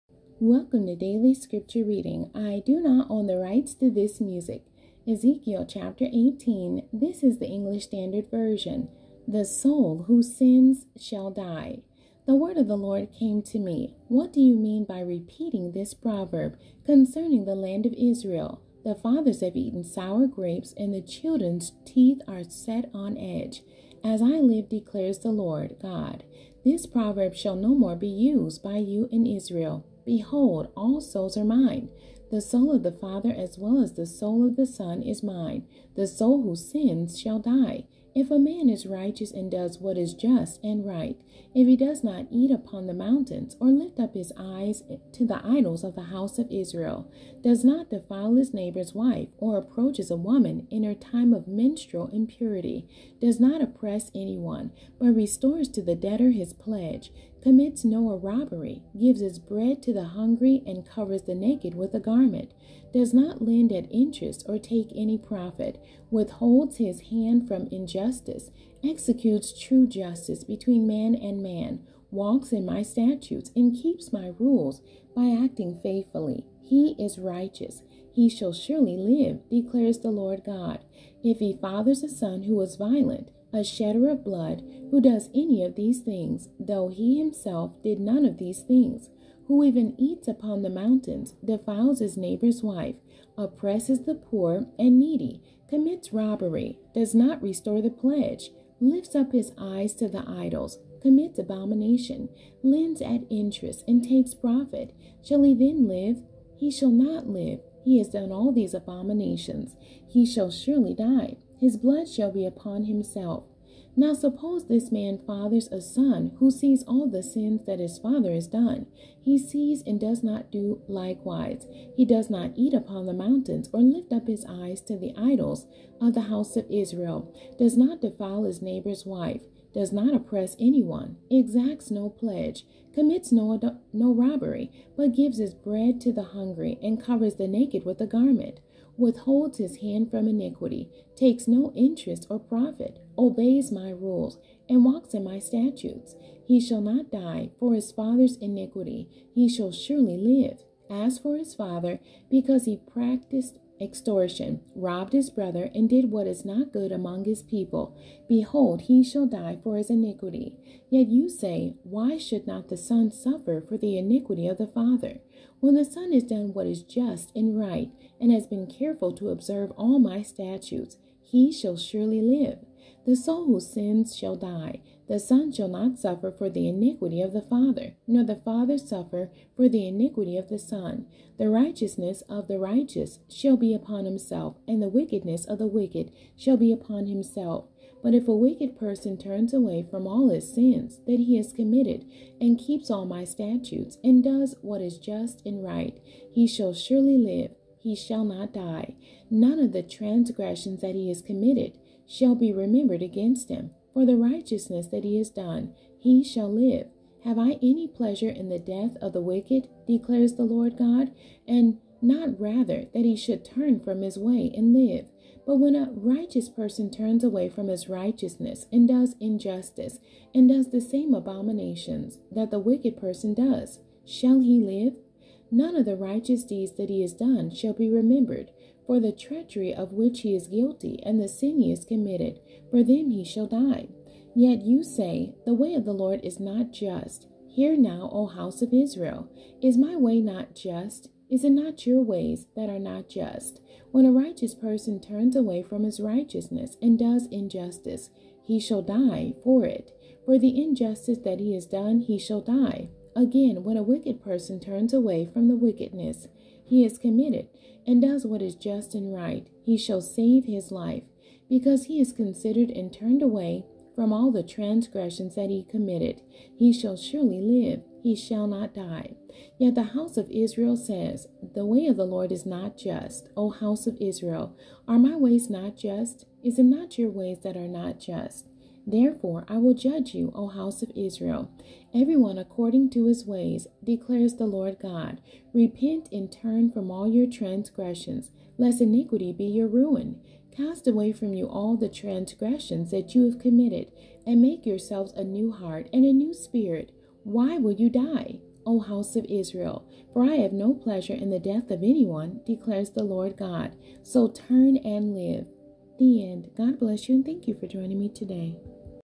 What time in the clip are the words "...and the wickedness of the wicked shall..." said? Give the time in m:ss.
3:04.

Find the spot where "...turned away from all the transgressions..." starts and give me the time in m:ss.
4:22.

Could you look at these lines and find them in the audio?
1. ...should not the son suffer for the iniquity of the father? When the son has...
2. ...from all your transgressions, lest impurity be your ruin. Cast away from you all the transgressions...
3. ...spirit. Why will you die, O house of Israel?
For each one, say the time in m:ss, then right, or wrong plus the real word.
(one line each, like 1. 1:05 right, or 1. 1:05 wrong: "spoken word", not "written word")
1. 2:42 right
2. 4:46 wrong: "iniquity", not "impurity"
3. 4:56 right.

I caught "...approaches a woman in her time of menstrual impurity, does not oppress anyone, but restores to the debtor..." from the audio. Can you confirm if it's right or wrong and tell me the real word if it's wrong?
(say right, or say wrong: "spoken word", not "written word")
right.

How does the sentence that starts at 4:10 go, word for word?
For the injustice that he has done, he shall die.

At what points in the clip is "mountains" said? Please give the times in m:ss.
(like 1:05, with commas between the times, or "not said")
0:42, 1:30, 2:03.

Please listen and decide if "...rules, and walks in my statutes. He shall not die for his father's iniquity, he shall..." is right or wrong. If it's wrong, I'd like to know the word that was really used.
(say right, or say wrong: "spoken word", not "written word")
right.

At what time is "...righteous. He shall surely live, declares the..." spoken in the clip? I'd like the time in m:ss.
1:17.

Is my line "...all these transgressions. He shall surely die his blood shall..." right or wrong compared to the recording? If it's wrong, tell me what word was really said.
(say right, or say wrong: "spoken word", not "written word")
wrong: "abominations", not "transgressions".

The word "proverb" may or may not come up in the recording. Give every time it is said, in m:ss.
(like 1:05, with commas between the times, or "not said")
0:15, 0:26.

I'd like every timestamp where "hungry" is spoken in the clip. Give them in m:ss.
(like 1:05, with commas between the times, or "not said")
1:00, 2:16.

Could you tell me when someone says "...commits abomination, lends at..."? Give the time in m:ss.
1:41.